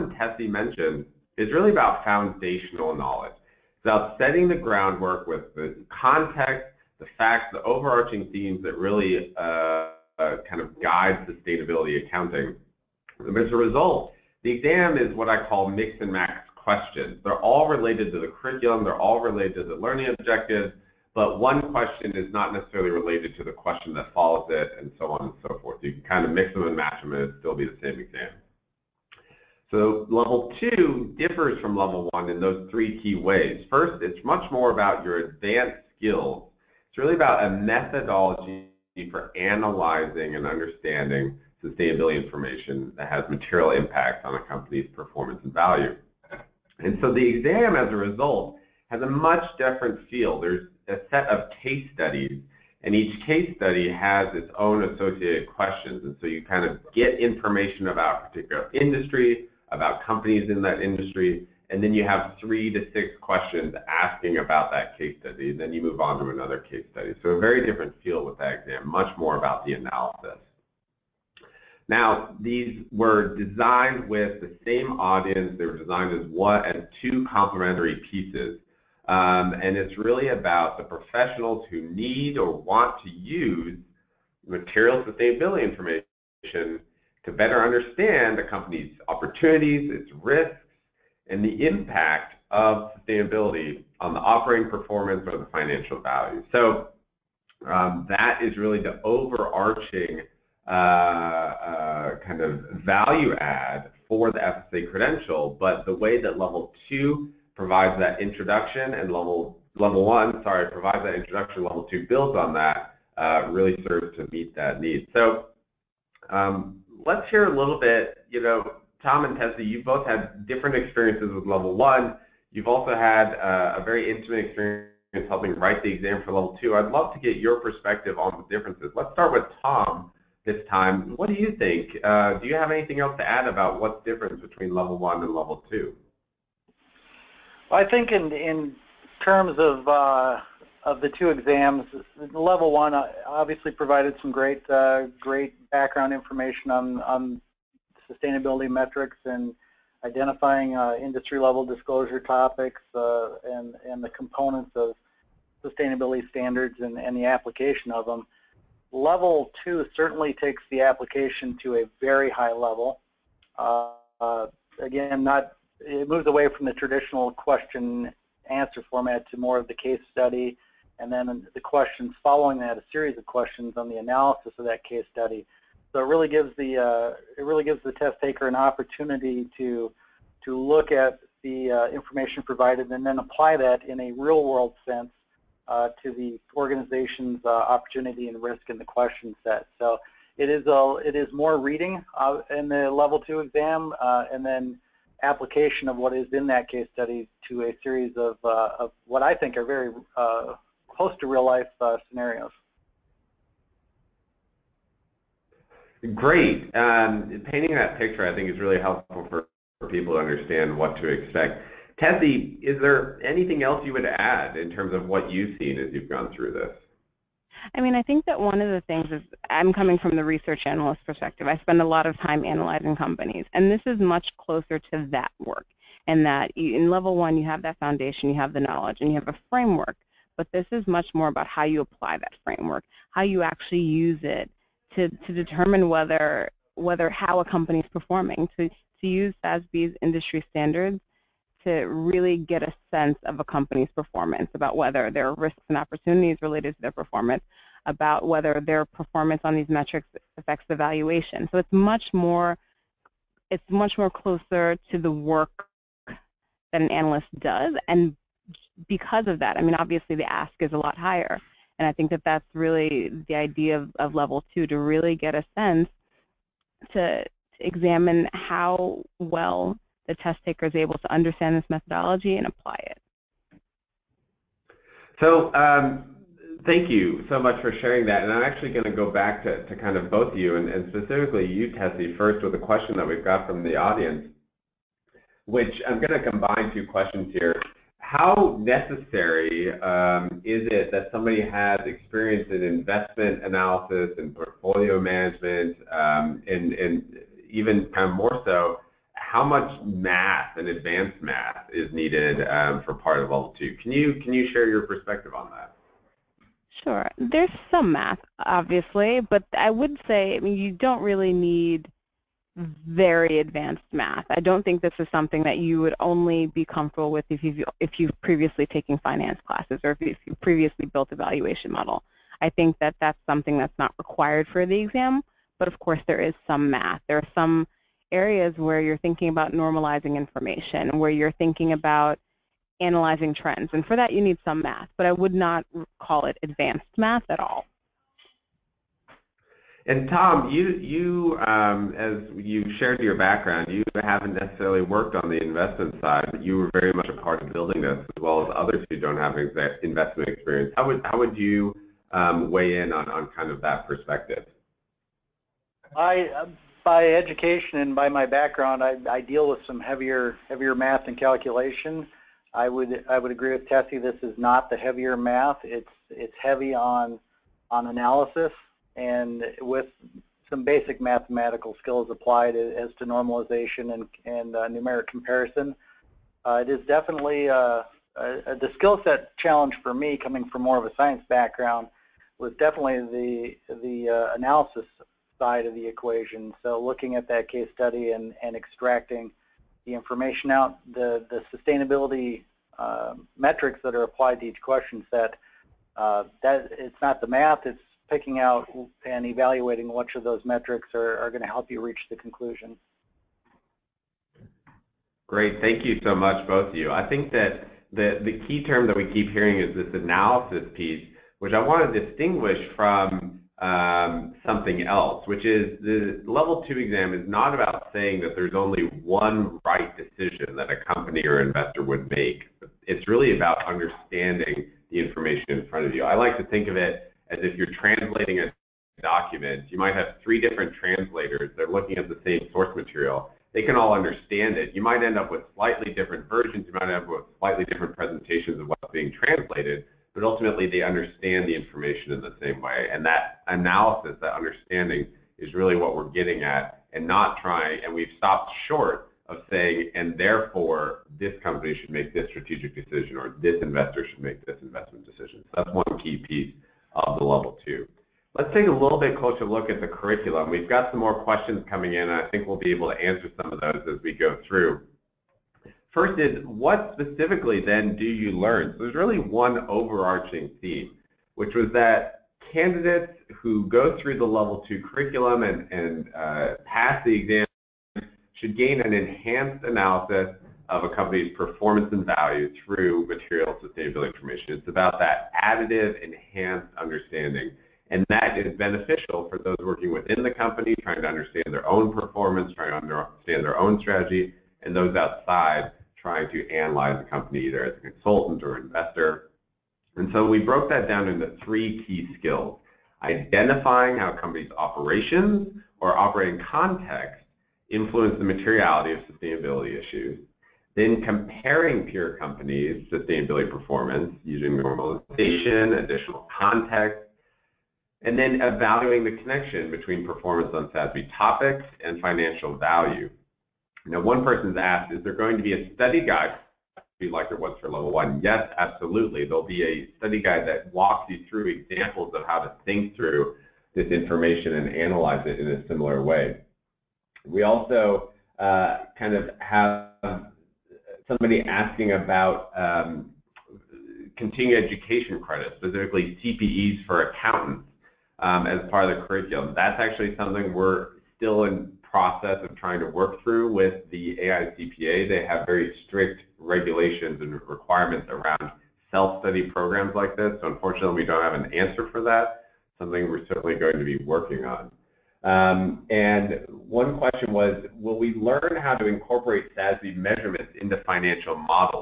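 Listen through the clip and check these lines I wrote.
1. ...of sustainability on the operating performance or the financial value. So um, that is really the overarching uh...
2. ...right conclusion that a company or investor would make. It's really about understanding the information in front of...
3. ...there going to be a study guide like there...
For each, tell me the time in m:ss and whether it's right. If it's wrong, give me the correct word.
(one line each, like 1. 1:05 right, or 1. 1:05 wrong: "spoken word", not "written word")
1. 1:32 right
2. 6:59 wrong: "decision", not "conclusion"
3. 8:45 right.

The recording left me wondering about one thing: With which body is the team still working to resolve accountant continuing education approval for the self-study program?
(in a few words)
AICPA.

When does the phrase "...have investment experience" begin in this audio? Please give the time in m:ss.
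5:49.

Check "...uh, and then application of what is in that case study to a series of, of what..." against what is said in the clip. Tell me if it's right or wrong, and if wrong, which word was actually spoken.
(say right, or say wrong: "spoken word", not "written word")
right.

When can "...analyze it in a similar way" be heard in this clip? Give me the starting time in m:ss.
8:54.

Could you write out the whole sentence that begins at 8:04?
It's about that additive, enhanced understanding.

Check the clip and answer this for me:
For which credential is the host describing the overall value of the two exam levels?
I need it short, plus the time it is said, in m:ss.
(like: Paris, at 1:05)
FSA, at 1:44.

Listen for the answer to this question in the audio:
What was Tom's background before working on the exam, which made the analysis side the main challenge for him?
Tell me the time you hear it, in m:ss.
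6:20.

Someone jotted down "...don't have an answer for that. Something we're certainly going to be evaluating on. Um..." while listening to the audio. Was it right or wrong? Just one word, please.
wrong.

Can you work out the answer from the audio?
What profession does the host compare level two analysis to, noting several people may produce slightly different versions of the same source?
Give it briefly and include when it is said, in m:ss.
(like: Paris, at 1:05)
translators, at 7:10.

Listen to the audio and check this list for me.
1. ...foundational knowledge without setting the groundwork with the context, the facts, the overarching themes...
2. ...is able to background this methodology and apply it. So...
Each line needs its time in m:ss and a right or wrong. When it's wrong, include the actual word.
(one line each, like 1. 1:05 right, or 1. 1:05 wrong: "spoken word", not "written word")
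1. 0:02 right
2. 4:30 wrong: "understand", not "background".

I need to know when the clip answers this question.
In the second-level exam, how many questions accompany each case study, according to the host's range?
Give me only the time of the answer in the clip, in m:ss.
1:02.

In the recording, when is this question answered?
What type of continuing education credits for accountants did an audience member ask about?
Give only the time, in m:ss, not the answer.
9:06.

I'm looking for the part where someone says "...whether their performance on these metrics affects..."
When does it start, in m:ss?
4:08.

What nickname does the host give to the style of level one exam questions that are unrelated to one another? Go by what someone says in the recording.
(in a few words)
mix and max questions.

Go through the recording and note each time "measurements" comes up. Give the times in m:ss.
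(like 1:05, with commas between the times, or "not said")
9:29.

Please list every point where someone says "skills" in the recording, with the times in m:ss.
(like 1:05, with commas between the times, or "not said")
0:35, 6:11, 6:18, 8:22.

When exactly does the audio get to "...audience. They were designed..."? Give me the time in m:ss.
1:14.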